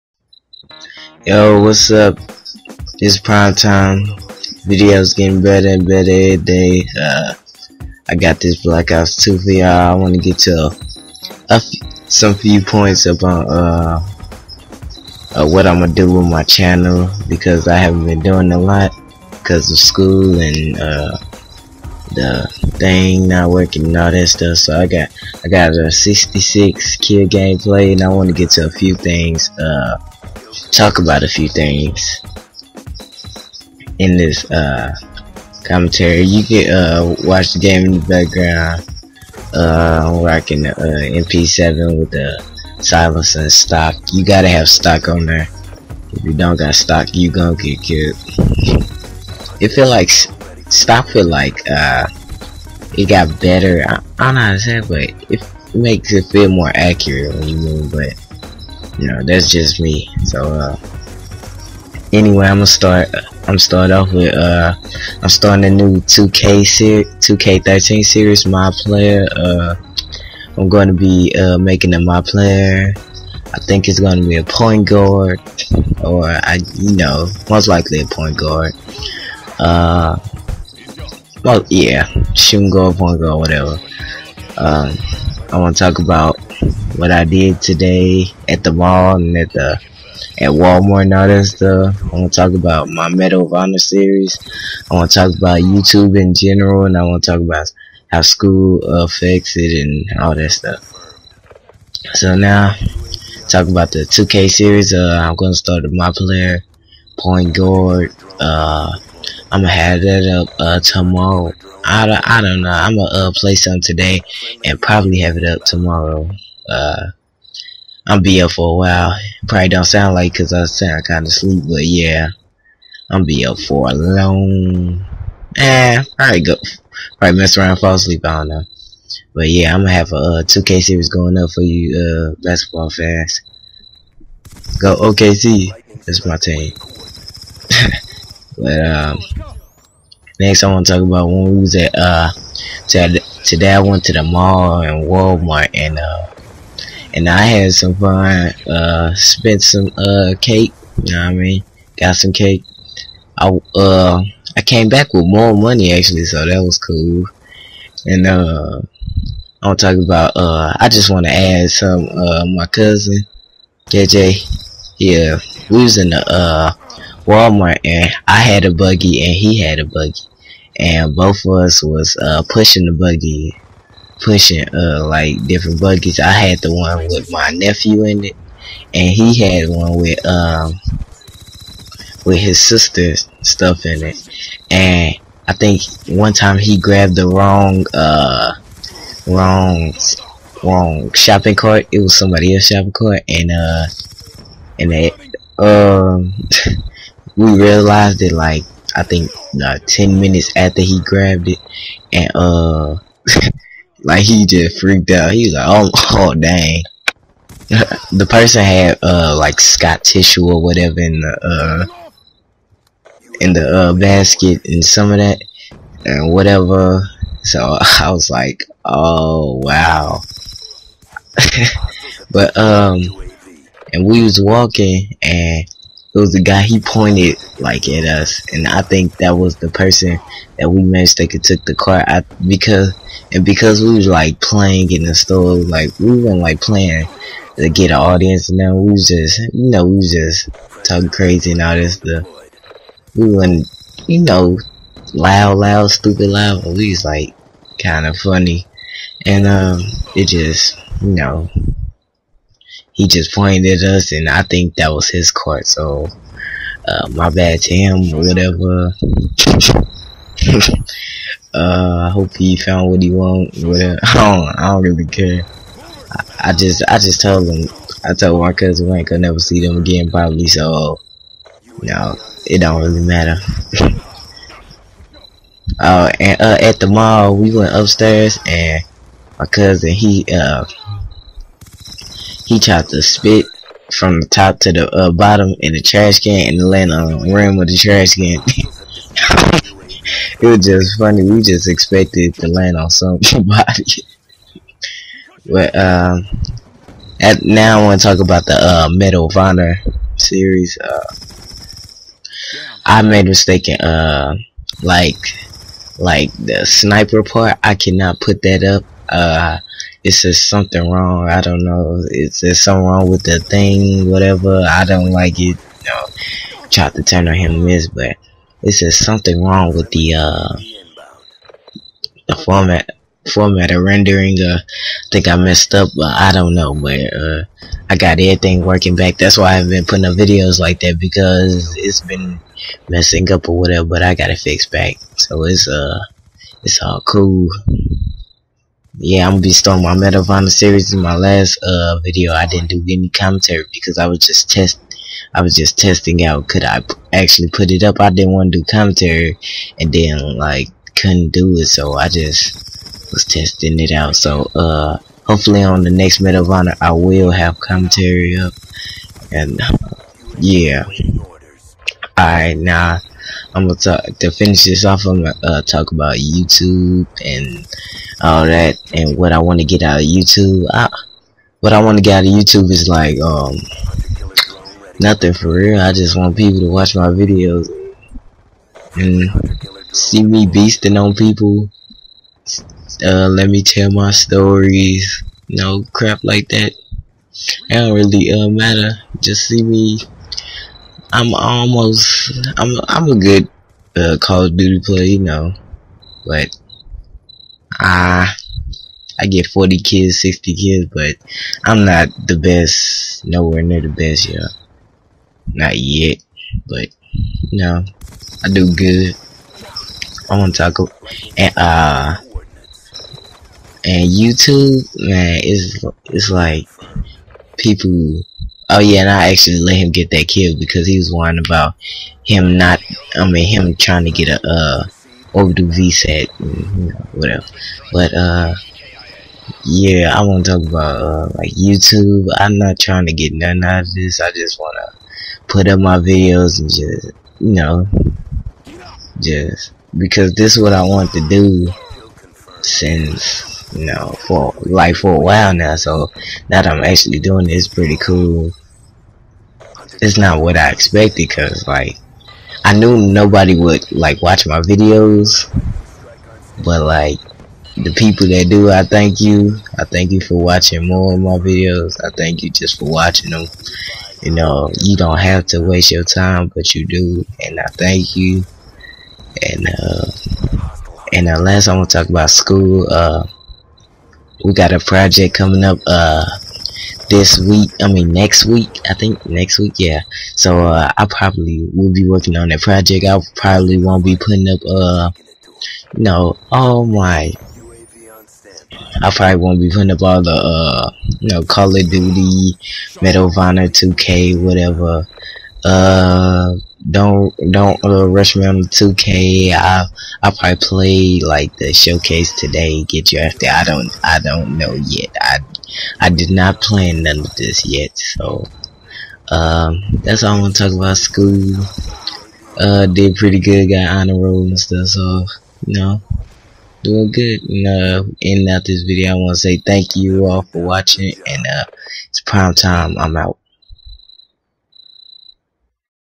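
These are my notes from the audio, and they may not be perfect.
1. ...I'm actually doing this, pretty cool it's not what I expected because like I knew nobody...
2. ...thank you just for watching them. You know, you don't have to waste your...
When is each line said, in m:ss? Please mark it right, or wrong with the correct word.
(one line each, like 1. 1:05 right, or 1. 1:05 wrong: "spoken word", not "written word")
1. 7:26 right
2. 7:42 right.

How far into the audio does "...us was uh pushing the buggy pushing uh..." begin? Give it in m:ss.
2:51.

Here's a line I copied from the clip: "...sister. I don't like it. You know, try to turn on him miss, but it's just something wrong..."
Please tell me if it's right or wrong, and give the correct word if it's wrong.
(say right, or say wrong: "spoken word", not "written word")
wrong: "whatever", not "sister".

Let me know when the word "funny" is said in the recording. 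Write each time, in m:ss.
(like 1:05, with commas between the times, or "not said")
4:08, 4:50.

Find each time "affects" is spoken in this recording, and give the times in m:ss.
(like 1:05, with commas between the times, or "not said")
1:38.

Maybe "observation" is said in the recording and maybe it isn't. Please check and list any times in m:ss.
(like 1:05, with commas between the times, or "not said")
not said.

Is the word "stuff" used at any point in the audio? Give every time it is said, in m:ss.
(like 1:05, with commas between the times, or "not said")
0:24, 1:31, 1:40, 3:03, 4:01, 8:34.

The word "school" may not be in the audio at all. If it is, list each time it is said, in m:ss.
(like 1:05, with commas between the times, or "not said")
0:19, 1:38, 7:52, 8:30.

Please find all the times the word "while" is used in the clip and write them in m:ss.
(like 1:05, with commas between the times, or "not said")
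1:58, 7:25.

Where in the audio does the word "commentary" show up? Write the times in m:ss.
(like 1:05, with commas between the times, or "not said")
0:35, 5:43, 5:48, 5:57.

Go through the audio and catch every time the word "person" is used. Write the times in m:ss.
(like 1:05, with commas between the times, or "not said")
3:28, 3:49.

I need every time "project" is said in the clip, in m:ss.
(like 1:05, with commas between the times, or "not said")
7:54, 8:02.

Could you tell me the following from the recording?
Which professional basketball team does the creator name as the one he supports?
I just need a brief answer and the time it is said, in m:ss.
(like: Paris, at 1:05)
OKC, at 2:14.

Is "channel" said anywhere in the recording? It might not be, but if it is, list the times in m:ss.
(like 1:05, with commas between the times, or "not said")
0:16.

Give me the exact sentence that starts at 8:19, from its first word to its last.
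I I probably play like the showcase today.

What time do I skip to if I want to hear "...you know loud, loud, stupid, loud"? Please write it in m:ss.
4:04.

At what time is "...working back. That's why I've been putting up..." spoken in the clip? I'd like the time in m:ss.
5:28.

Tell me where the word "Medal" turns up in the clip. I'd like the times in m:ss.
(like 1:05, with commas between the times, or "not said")
1:33, 4:58, 5:39, 5:56, 8:13.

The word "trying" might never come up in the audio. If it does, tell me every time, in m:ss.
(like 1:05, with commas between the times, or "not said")
7:03, 7:12.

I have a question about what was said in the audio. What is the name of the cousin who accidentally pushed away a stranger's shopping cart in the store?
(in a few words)
JJ.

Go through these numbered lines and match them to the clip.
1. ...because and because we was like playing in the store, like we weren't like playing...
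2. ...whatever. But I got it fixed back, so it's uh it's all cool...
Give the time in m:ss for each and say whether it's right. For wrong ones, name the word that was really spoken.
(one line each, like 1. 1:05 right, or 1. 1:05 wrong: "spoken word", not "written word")
1. 3:52 right
2. 5:33 right.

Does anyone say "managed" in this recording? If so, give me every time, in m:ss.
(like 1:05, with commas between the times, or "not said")
3:50.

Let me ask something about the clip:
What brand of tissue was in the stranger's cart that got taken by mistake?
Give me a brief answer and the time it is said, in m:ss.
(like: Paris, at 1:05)
Scott, at 3:29.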